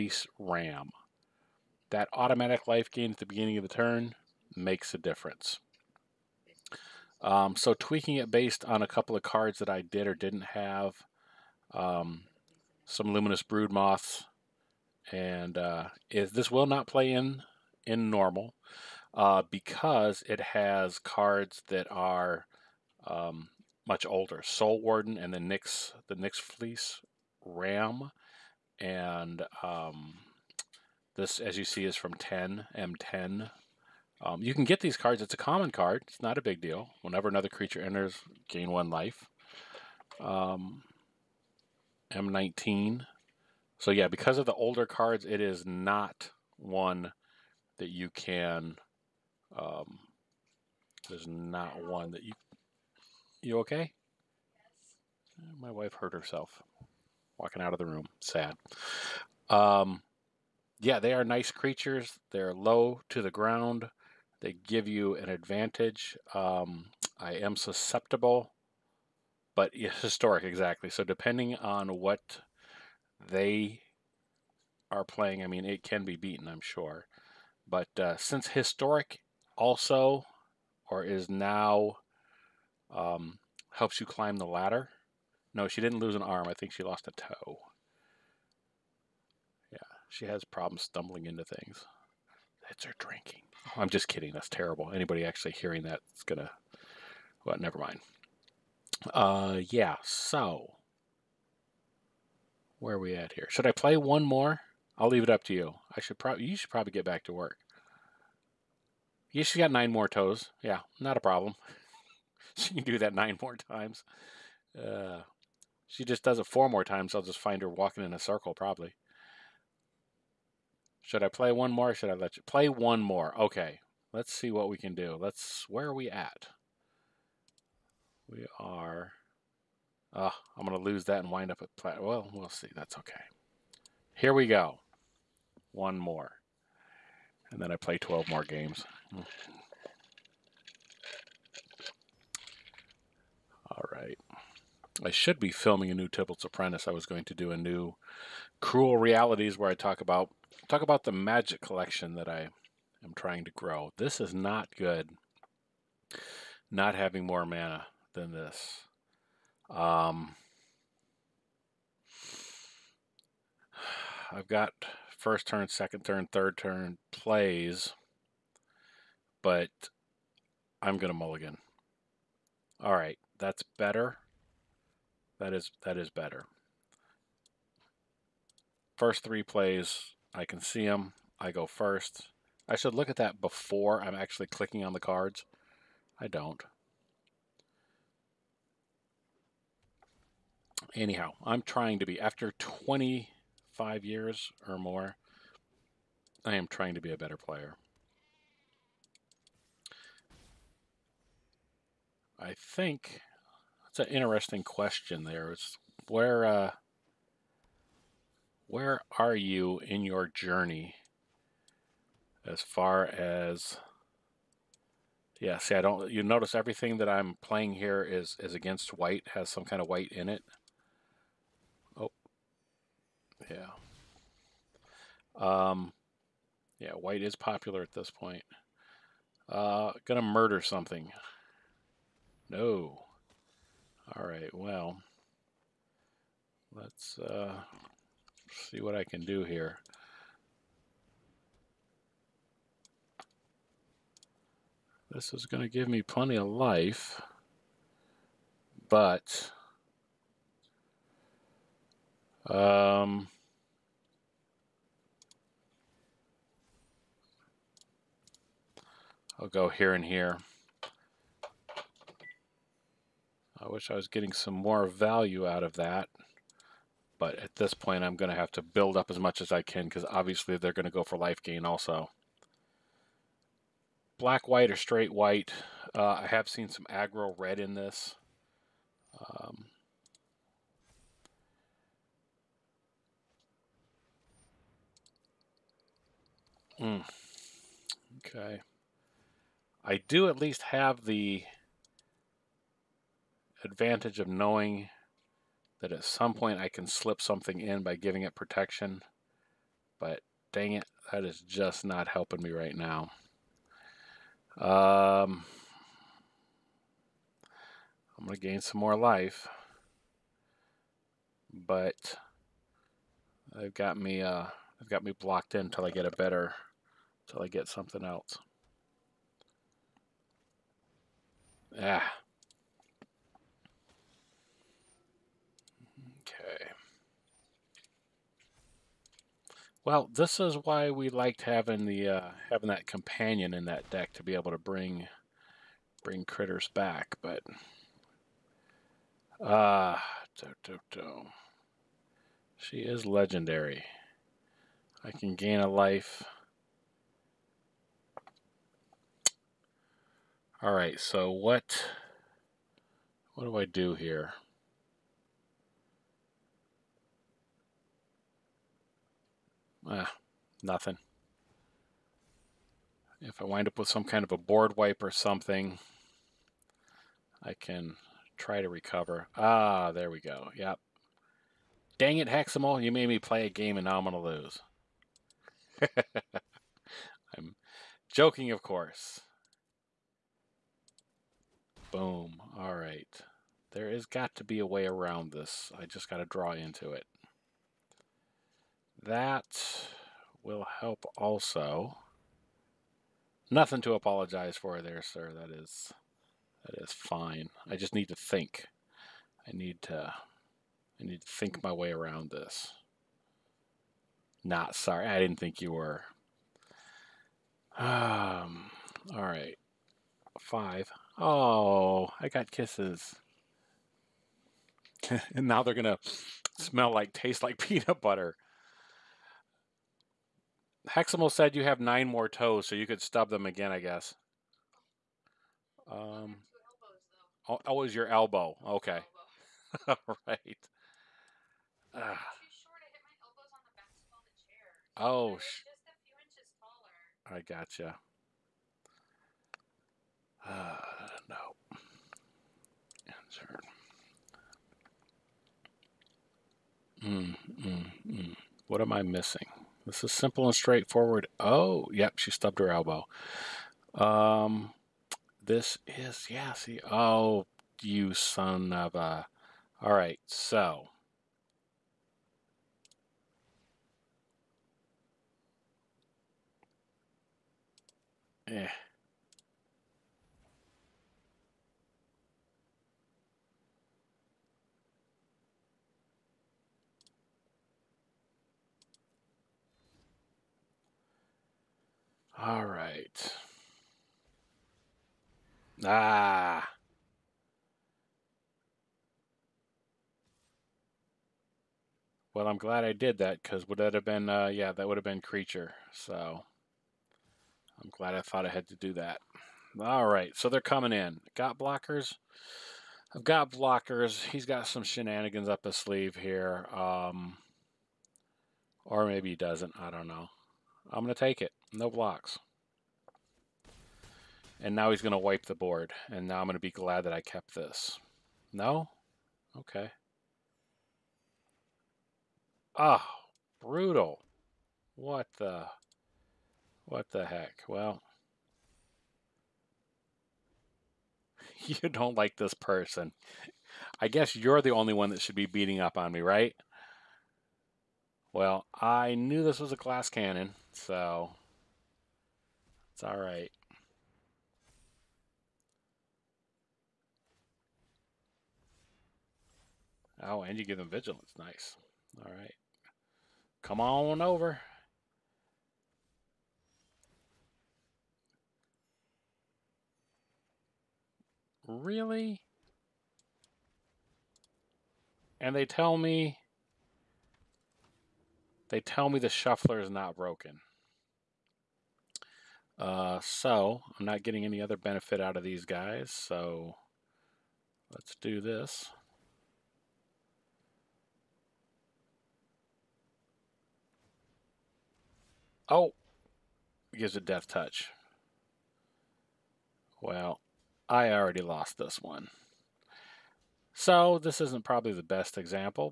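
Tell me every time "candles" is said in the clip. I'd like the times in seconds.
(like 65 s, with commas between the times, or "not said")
not said.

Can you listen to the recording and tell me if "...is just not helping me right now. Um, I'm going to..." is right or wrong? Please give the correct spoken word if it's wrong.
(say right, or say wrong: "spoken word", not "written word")
right.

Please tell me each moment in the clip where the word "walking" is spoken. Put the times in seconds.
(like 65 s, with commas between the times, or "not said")
57 s, 117 s.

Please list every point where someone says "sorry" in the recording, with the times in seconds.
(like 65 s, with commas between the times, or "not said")
404 s.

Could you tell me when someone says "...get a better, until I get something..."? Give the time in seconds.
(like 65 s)
315 s.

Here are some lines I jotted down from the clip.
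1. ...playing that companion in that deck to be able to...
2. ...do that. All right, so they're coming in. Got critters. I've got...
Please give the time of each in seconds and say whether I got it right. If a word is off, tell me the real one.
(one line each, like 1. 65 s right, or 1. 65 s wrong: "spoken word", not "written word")
1. 332 s wrong: "having", not "playing"
2. 498 s wrong: "blockers", not "critters".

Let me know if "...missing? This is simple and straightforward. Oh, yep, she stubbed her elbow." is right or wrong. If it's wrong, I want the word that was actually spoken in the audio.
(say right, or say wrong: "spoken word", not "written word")
right.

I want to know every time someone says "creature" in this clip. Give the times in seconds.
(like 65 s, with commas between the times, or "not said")
37 s, 61 s, 495 s.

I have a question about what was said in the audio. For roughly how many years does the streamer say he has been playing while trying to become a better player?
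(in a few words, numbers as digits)
25.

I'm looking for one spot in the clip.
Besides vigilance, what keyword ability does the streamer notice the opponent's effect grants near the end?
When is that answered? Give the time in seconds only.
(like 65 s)
587 s.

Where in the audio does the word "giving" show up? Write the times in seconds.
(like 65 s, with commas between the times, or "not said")
297 s.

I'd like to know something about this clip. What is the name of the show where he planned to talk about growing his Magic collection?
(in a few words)
Cruel Realities.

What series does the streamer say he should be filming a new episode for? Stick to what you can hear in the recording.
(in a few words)
Tibalt's Apprentice.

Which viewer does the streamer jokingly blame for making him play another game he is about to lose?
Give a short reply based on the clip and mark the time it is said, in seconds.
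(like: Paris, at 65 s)
Hexamal, at 372 s.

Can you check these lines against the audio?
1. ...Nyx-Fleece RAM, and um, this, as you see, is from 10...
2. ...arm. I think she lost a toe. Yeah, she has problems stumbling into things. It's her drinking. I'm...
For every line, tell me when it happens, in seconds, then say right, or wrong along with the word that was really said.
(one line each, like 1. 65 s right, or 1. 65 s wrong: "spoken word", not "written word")
1. 26 s right
2. 86 s right.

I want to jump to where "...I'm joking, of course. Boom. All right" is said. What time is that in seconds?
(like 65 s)
377 s.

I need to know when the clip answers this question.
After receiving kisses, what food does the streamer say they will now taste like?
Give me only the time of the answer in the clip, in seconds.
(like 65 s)
417 s.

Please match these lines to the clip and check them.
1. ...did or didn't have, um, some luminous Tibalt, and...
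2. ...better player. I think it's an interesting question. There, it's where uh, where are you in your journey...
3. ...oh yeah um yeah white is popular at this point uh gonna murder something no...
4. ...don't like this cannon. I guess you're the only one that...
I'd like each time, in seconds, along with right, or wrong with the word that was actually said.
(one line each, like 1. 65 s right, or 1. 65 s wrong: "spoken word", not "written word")
1. 9 s wrong: "Broodmoths", not "Tibalt"
2. 197 s right
3. 221 s right
4. 531 s wrong: "person", not "cannon".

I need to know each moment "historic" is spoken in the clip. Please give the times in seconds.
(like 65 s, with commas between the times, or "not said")
70 s, 78 s.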